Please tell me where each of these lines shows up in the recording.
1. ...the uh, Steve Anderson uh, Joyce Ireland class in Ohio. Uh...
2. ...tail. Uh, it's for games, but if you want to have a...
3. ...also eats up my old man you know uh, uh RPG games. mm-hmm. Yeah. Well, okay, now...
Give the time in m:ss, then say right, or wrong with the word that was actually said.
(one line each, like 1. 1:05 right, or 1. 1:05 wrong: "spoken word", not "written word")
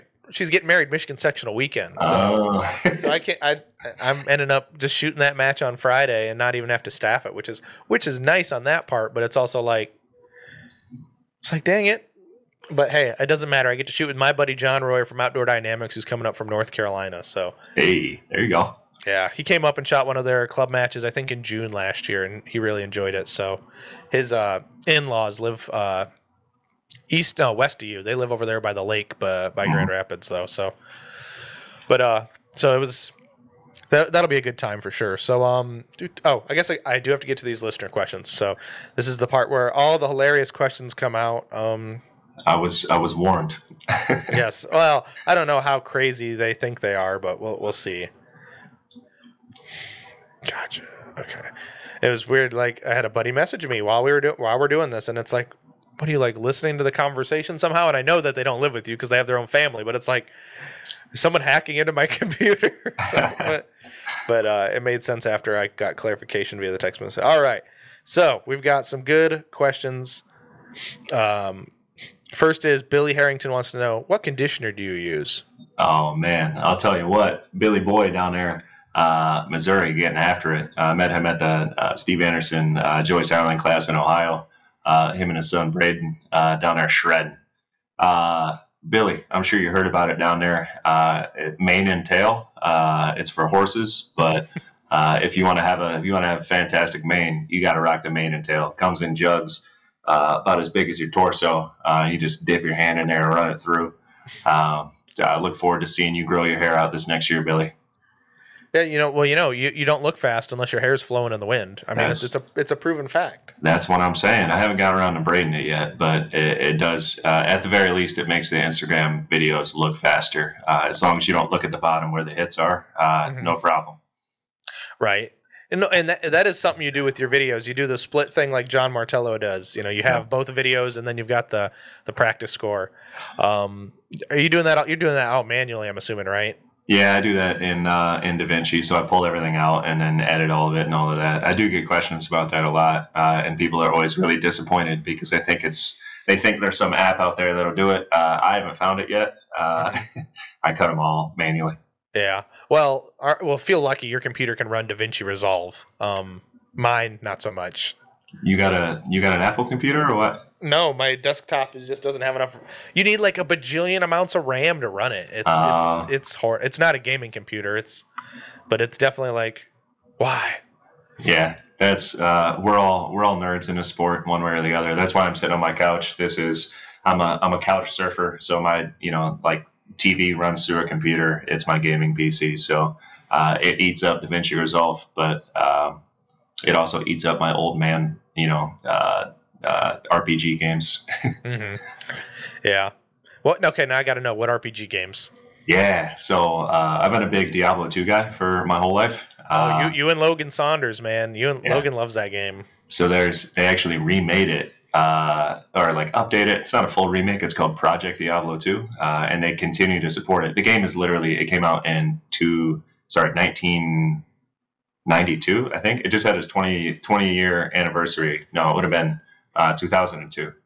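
1. 1:21 right
2. 1:32 wrong: "horses", not "games"
3. 3:06 right.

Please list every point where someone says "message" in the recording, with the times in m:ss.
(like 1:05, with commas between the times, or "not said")
0:53, 1:06.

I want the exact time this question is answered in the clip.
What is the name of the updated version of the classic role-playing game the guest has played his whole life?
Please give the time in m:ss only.
3:27.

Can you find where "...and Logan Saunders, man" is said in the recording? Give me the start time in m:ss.
3:20.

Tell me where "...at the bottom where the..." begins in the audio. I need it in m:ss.
2:01.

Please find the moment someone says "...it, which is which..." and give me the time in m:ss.
0:07.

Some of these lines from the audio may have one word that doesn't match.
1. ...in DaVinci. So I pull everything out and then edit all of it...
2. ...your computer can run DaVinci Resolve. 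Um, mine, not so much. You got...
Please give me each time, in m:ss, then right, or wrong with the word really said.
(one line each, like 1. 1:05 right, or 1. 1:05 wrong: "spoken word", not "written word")
1. 2:18 right
2. 2:34 right.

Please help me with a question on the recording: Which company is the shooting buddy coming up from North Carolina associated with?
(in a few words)
Outdoor Dynamics.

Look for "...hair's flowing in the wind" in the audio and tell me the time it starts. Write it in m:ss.
1:50.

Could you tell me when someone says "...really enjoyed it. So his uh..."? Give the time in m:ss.
0:22.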